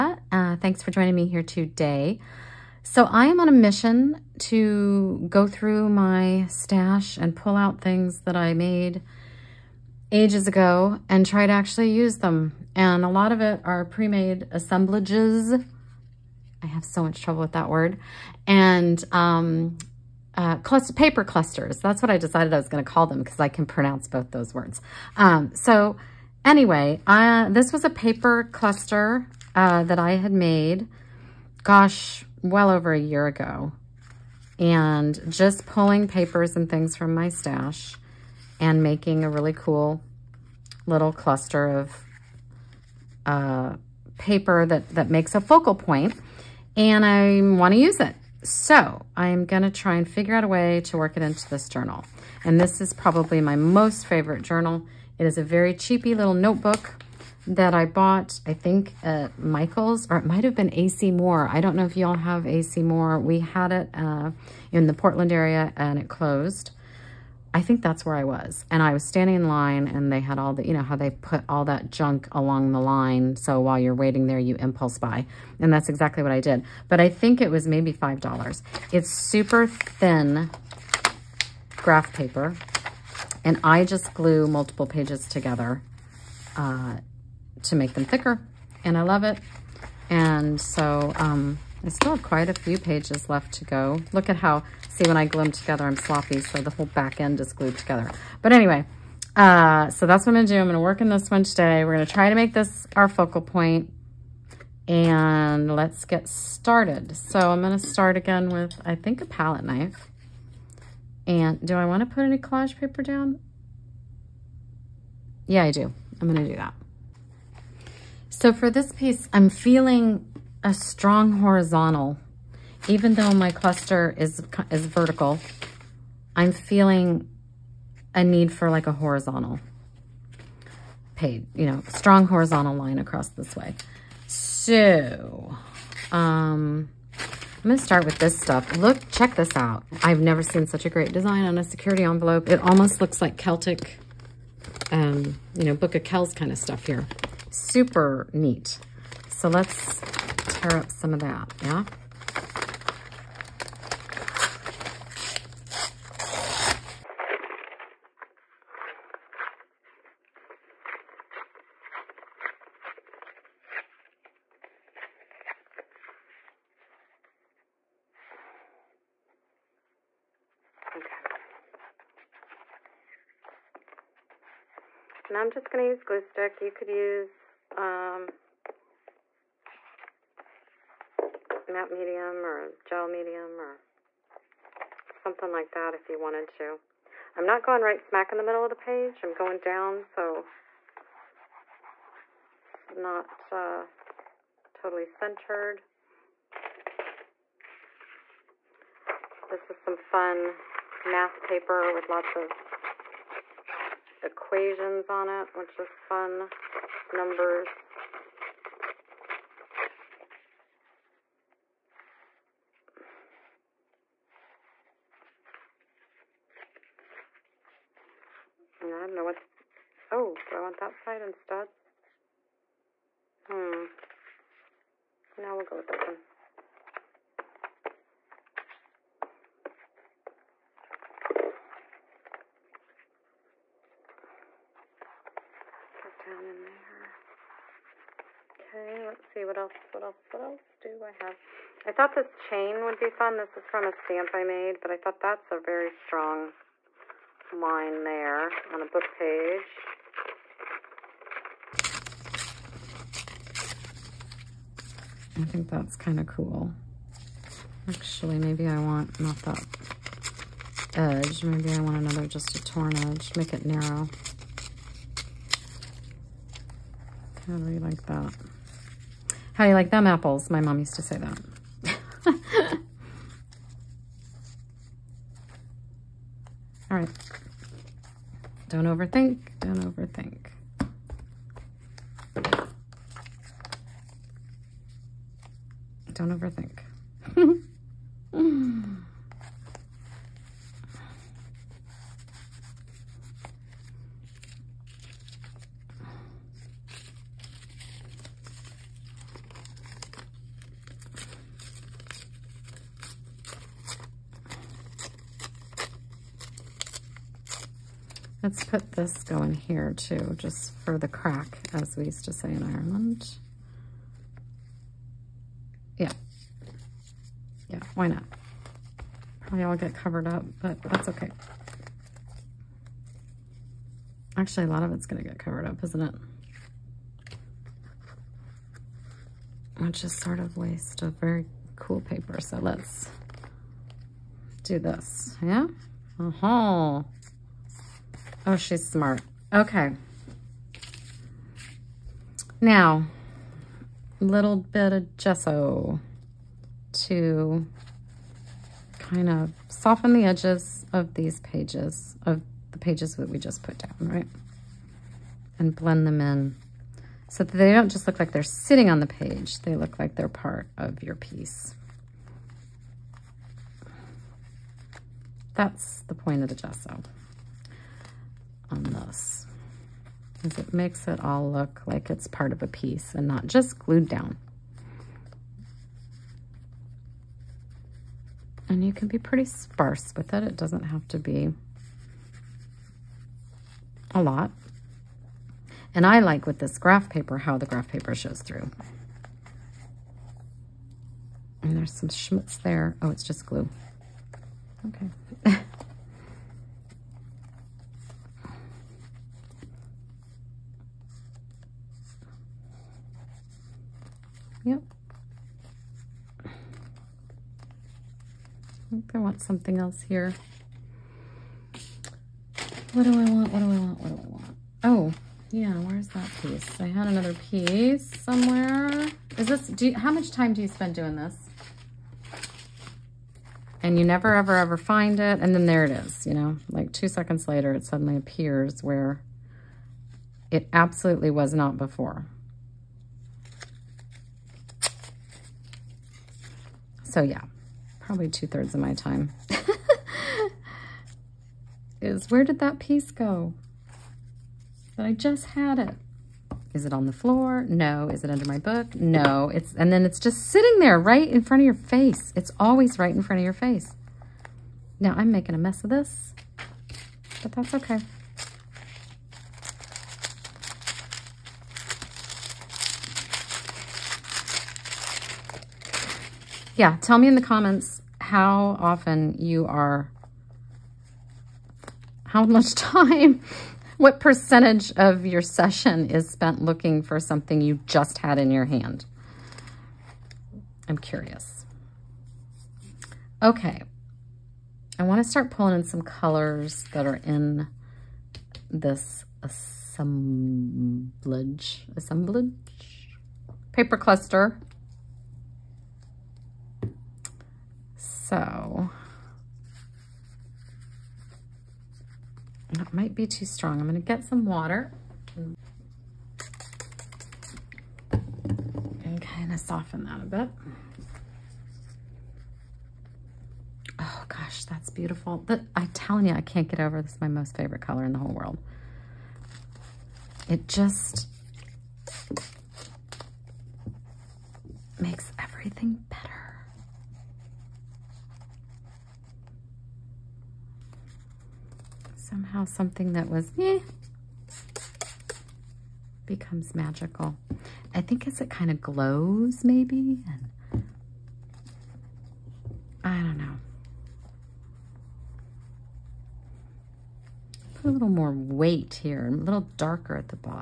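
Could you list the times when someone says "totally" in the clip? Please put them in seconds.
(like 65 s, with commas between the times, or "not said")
194 s.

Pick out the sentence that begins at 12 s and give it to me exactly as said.
And a lot of it are pre-made assemblages.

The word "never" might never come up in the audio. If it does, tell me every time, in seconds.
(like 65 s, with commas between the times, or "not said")
140 s, 424 s.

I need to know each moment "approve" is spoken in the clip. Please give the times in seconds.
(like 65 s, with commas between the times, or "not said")
not said.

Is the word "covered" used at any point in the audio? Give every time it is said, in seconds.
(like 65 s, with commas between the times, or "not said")
319 s, 325 s.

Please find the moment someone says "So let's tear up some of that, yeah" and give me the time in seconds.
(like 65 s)
149 s.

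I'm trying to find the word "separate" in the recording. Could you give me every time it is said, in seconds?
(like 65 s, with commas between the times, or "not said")
not said.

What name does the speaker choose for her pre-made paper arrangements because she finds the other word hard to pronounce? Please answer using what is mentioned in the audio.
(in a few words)
paper clusters.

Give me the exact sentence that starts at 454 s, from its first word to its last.
Now I'm making a mess of this, but that's okay.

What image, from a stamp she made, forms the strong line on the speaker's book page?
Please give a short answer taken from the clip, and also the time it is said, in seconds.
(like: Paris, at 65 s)
chain, at 242 s.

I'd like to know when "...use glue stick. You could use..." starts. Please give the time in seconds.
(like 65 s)
175 s.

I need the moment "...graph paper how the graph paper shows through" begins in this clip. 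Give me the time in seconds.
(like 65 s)
386 s.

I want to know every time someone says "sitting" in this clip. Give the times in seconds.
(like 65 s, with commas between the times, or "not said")
358 s, 450 s.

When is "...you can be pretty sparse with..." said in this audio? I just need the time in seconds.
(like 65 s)
378 s.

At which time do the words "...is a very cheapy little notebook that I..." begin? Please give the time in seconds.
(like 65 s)
55 s.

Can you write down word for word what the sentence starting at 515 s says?
But I'm telling you, I can't get over this is my most favorite color in the whole world.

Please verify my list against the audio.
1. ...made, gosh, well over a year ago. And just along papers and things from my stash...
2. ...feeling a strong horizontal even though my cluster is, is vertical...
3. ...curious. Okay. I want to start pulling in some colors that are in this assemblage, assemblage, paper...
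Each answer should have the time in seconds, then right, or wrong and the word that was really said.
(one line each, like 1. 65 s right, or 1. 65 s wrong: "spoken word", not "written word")
1. 30 s wrong: "pulling", not "along"
2. 119 s right
3. 480 s right.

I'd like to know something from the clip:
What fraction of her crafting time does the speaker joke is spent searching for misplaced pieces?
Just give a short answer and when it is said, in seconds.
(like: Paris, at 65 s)
two thirds, at 438 s.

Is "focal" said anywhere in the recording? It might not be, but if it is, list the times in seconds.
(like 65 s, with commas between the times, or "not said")
45 s, 103 s.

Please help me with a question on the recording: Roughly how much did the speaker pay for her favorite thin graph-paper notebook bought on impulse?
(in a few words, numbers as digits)
$5.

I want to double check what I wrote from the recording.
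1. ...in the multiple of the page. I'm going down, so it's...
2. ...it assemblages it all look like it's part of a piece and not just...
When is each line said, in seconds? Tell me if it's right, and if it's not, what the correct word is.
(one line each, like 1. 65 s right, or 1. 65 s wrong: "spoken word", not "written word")
1. 188 s wrong: "middle", not "multiple"
2. 370 s wrong: "makes", not "assemblages".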